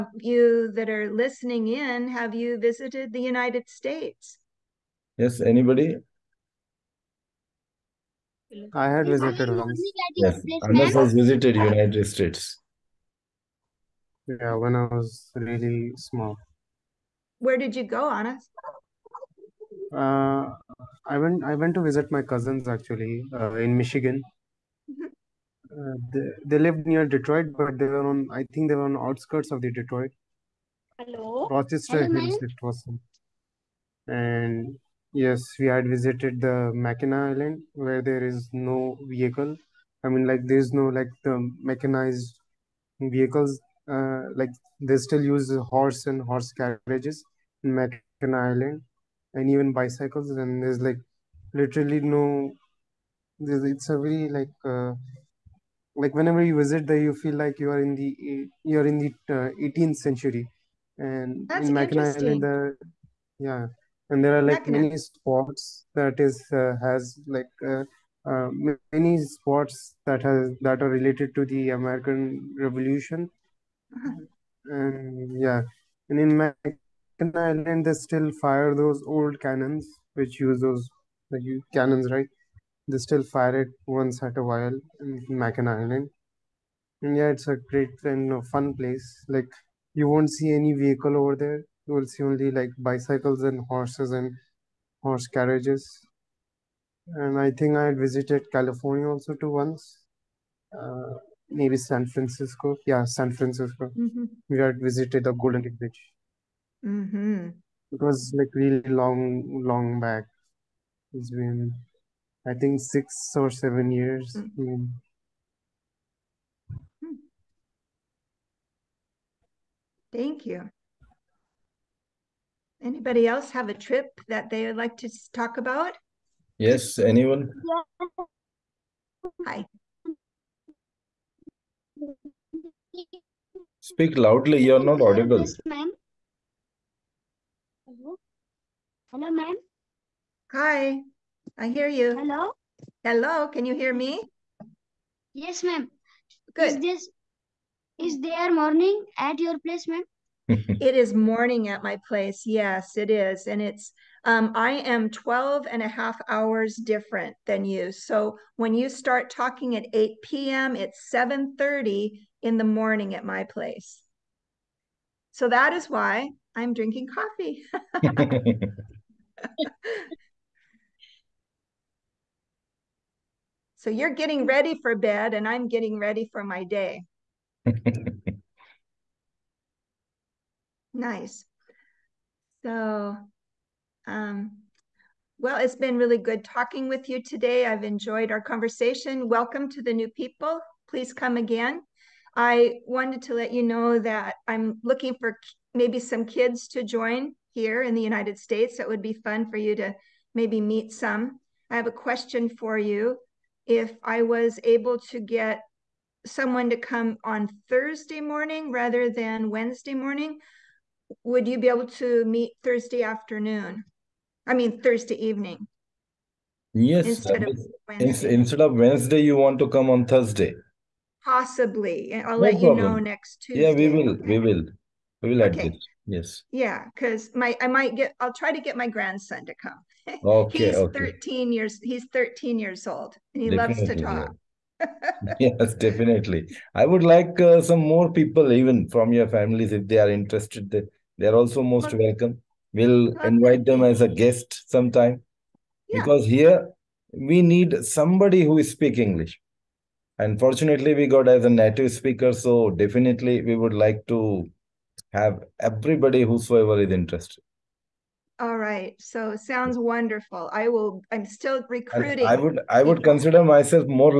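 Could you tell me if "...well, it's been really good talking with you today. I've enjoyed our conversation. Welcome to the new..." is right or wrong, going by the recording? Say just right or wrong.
right.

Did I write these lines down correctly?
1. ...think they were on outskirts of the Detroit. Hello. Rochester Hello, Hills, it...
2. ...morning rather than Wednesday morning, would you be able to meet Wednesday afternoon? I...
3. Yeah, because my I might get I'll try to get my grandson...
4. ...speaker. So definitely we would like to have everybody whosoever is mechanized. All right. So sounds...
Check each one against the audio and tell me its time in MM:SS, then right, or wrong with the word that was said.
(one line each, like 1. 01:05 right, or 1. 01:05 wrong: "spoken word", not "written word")
1. 00:28 right
2. 03:28 wrong: "Thursday", not "Wednesday"
3. 03:46 right
4. 04:11 wrong: "interested", not "mechanized".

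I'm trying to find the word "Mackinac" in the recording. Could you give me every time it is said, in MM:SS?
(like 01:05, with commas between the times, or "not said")
00:36, 00:47, 01:01, 01:16, 01:25.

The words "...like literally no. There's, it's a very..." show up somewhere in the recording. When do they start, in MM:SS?
00:50.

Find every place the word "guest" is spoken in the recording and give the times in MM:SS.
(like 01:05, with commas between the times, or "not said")
04:04.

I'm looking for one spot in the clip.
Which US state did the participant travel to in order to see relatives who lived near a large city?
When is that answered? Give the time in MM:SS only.
00:23.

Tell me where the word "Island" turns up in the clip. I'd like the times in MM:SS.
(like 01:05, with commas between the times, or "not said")
00:37, 00:48, 01:02, 01:17, 01:25.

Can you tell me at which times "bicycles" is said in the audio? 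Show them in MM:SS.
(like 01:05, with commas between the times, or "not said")
00:49, 01:32.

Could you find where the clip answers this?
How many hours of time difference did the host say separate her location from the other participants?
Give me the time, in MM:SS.
02:35.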